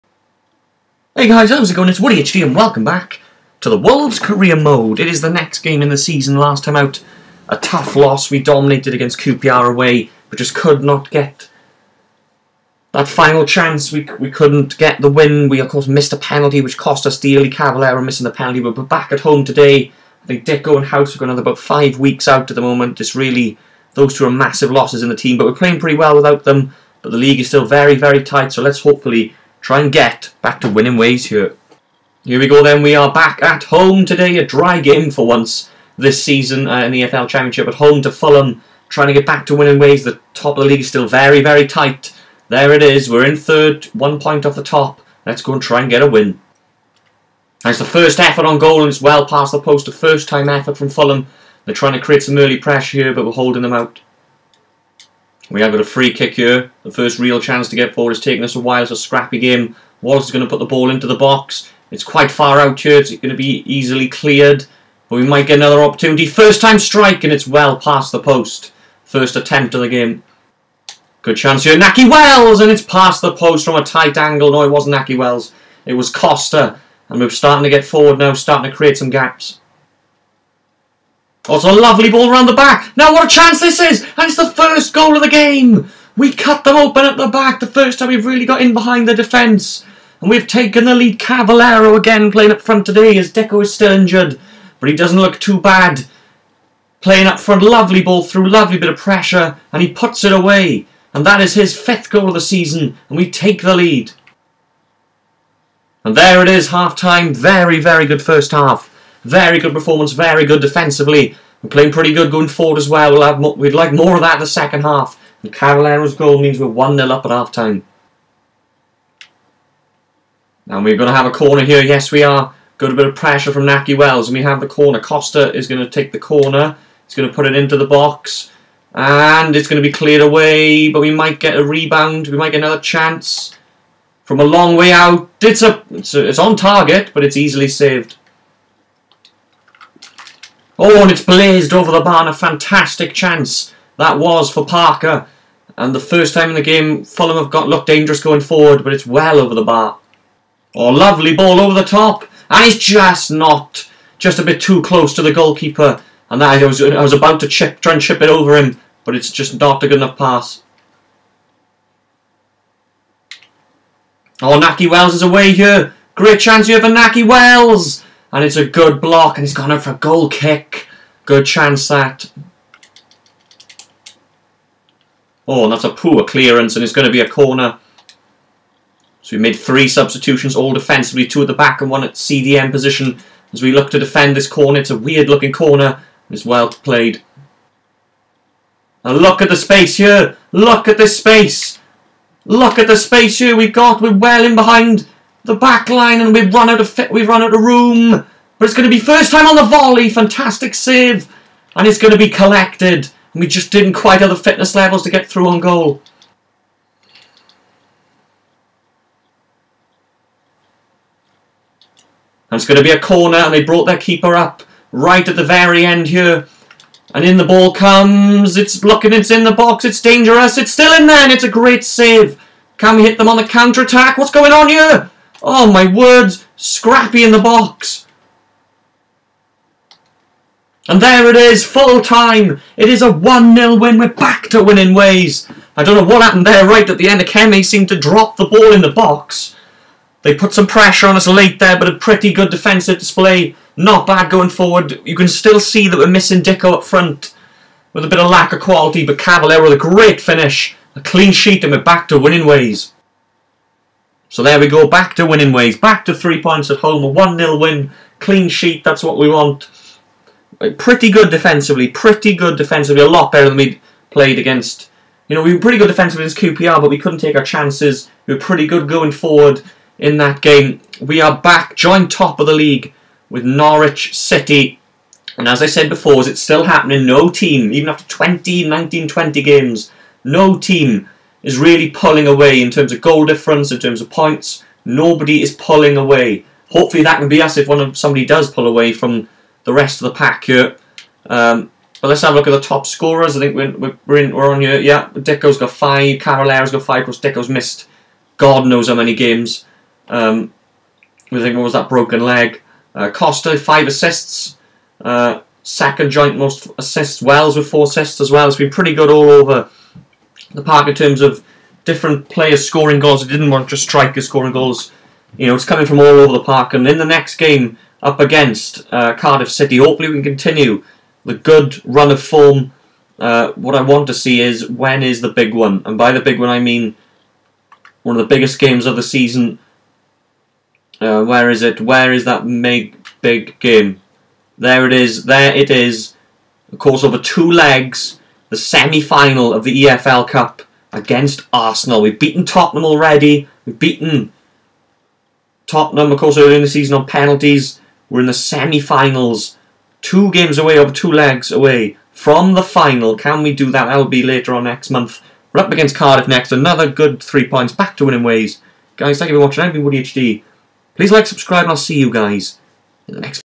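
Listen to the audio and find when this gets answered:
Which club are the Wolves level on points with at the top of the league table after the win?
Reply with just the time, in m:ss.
4:33.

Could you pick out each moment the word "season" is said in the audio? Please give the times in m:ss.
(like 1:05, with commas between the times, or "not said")
0:05, 0:36, 1:42, 5:29, 5:46.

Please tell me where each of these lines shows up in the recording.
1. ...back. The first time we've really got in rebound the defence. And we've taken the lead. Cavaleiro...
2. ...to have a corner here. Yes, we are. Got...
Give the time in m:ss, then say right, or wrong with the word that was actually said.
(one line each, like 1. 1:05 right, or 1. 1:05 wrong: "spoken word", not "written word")
1. 1:27 wrong: "behind", not "rebound"
2. 2:01 right.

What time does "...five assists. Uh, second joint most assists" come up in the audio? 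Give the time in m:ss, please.
5:03.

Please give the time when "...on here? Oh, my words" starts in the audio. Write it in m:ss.
3:44.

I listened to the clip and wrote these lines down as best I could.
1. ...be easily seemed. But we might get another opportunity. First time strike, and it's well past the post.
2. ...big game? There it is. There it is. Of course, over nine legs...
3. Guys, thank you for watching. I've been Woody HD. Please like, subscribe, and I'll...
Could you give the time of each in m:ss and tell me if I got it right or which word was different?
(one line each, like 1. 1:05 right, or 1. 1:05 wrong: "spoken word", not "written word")
1. 1:03 wrong: "cleared", not "seemed"
2. 5:33 wrong: "two", not "nine"
3. 5:58 right.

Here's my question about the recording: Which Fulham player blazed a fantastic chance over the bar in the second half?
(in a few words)
Parker.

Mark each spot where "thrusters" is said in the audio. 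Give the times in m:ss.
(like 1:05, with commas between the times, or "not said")
not said.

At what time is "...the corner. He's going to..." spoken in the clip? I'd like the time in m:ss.
2:06.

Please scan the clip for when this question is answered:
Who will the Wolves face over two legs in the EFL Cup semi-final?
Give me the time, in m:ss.
5:41.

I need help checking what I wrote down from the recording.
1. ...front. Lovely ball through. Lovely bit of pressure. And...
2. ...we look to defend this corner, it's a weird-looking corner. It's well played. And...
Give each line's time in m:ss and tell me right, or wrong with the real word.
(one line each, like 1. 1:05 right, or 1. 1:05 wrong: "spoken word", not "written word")
1. 1:37 right
2. 3:03 right.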